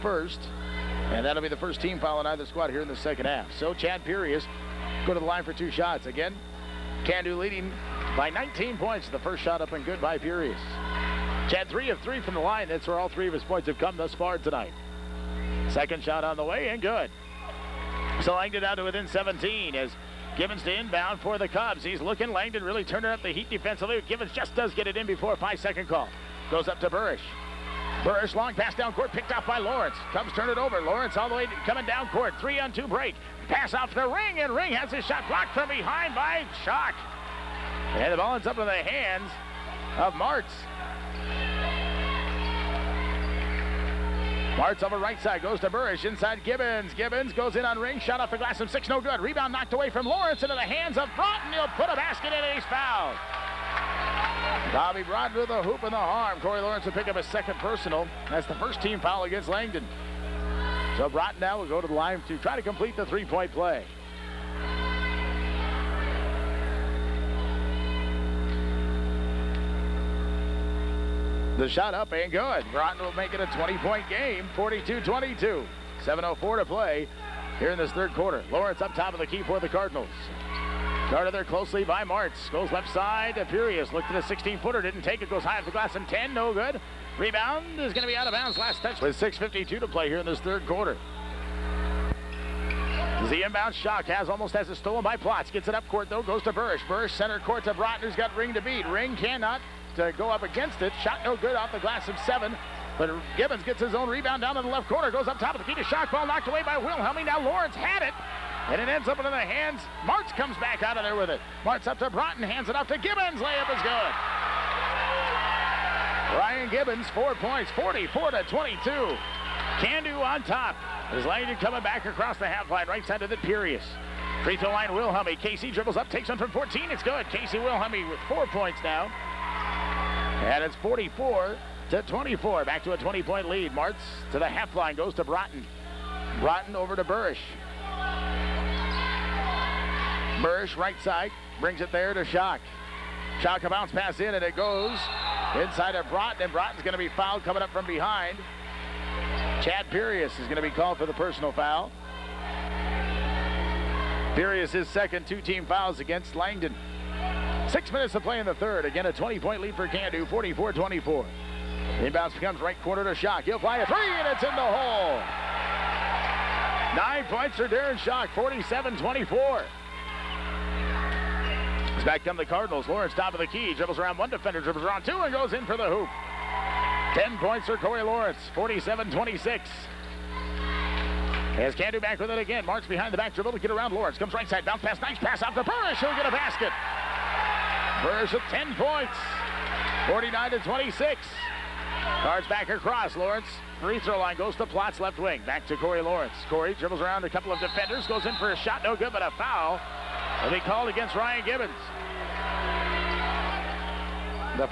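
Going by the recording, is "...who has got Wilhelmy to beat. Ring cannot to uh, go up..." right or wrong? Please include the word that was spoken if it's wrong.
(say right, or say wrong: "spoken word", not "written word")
wrong: "Ring", not "Wilhelmy".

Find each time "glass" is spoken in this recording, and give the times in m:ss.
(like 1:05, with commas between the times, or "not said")
0:48, 1:25, 1:41.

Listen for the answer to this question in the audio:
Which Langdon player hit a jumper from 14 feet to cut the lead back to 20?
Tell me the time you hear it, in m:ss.
2:07.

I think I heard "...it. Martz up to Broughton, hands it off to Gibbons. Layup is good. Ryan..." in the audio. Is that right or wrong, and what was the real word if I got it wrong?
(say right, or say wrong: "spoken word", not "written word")
right.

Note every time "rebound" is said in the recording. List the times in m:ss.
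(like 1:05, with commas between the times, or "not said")
0:49, 1:27, 1:44.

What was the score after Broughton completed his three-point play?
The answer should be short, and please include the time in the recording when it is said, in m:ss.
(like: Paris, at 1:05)
42-22, at 1:14.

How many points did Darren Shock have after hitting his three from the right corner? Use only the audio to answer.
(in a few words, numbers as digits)
9.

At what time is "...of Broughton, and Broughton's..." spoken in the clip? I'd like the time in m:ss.
2:25.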